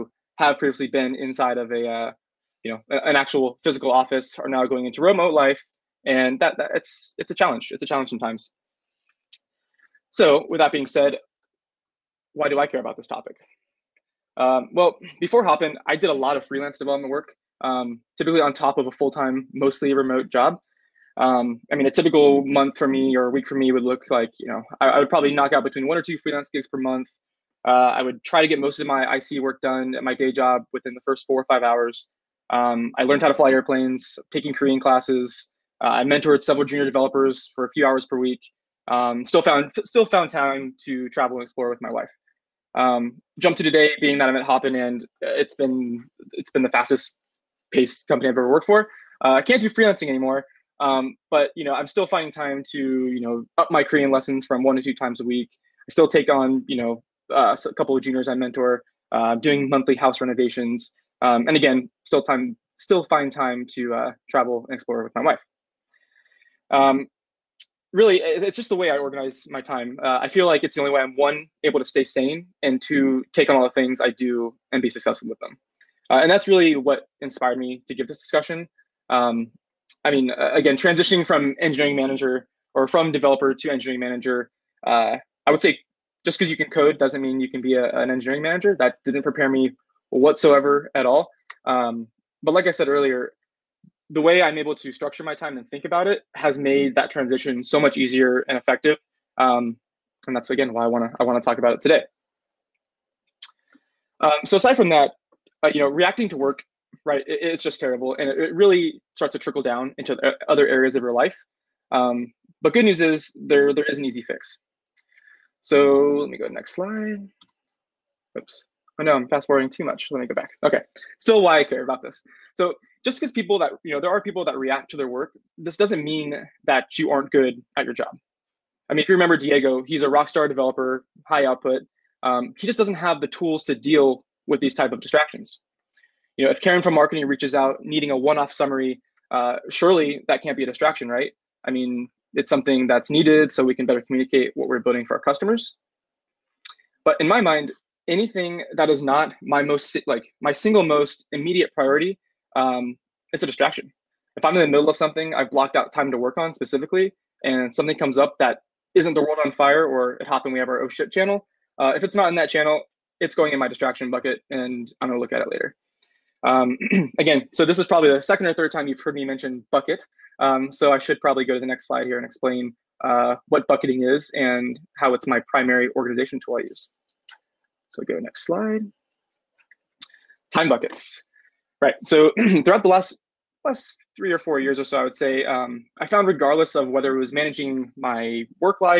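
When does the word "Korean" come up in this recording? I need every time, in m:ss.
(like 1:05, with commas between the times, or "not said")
0:34, 0:53.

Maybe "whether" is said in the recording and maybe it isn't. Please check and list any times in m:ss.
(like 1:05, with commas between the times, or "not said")
3:06.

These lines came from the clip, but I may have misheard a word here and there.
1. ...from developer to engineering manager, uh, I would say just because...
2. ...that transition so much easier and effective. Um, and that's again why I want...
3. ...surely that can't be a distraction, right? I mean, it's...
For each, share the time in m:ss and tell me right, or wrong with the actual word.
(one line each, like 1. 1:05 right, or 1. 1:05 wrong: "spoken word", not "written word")
1. 1:22 right
2. 1:36 right
3. 2:19 right.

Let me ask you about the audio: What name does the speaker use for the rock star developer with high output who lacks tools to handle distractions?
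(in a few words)
Diego.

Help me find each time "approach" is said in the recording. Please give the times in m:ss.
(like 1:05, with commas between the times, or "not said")
not said.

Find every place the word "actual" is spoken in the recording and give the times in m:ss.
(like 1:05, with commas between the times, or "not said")
0:03.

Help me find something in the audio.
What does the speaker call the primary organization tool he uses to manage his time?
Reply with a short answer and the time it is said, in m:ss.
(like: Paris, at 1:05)
Time buckets, at 3:00.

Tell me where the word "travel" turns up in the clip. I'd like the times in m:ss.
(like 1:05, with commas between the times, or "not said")
0:41, 1:04.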